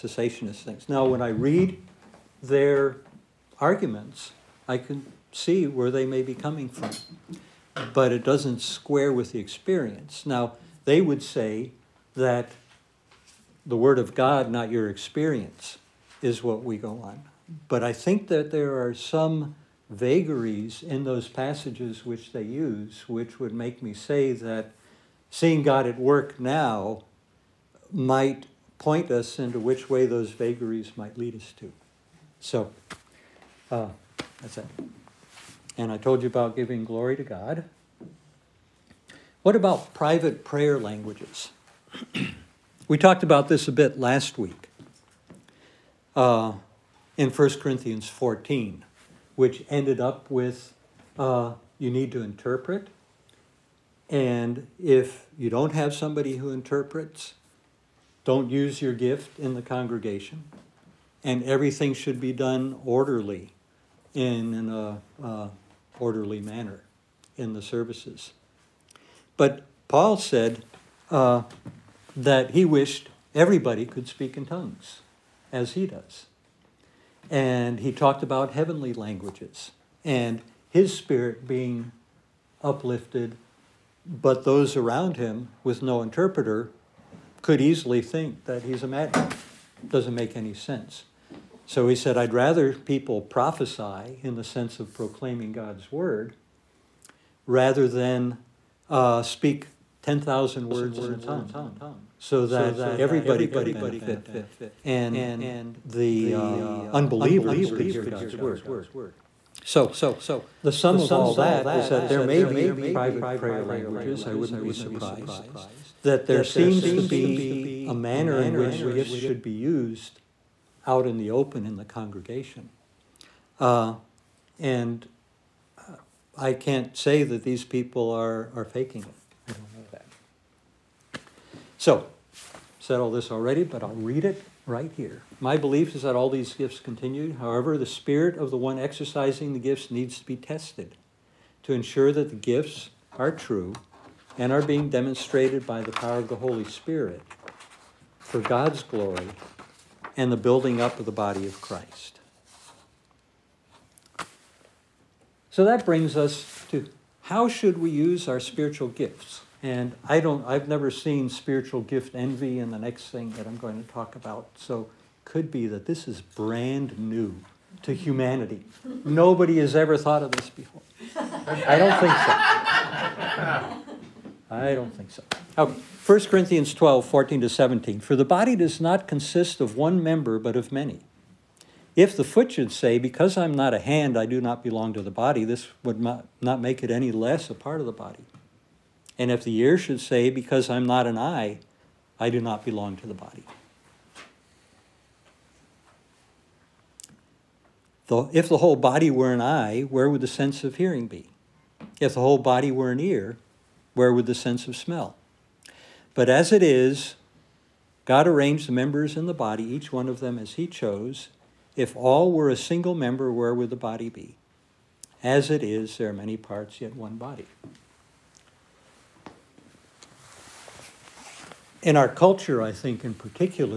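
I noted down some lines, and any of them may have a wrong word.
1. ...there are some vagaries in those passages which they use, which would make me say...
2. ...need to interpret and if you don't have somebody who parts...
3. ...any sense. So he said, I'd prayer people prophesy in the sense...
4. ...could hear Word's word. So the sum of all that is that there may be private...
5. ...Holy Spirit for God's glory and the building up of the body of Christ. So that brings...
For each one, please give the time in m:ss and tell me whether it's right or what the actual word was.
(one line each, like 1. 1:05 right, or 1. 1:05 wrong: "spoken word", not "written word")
1. 0:18 right
2. 0:51 wrong: "interprets", not "parts"
3. 1:30 wrong: "rather", not "prayer"
4. 1:47 wrong: "God", not "Word"
5. 2:26 right.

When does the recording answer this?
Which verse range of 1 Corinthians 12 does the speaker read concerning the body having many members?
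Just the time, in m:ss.
2:57.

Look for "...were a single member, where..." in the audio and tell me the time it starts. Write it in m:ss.
3:32.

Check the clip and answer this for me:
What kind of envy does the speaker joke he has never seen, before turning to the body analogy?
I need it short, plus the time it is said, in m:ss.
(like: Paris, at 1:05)
spiritual gift envy, at 2:41.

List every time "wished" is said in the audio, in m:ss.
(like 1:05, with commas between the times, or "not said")
1:12.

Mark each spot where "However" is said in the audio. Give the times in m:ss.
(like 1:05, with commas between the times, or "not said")
2:17.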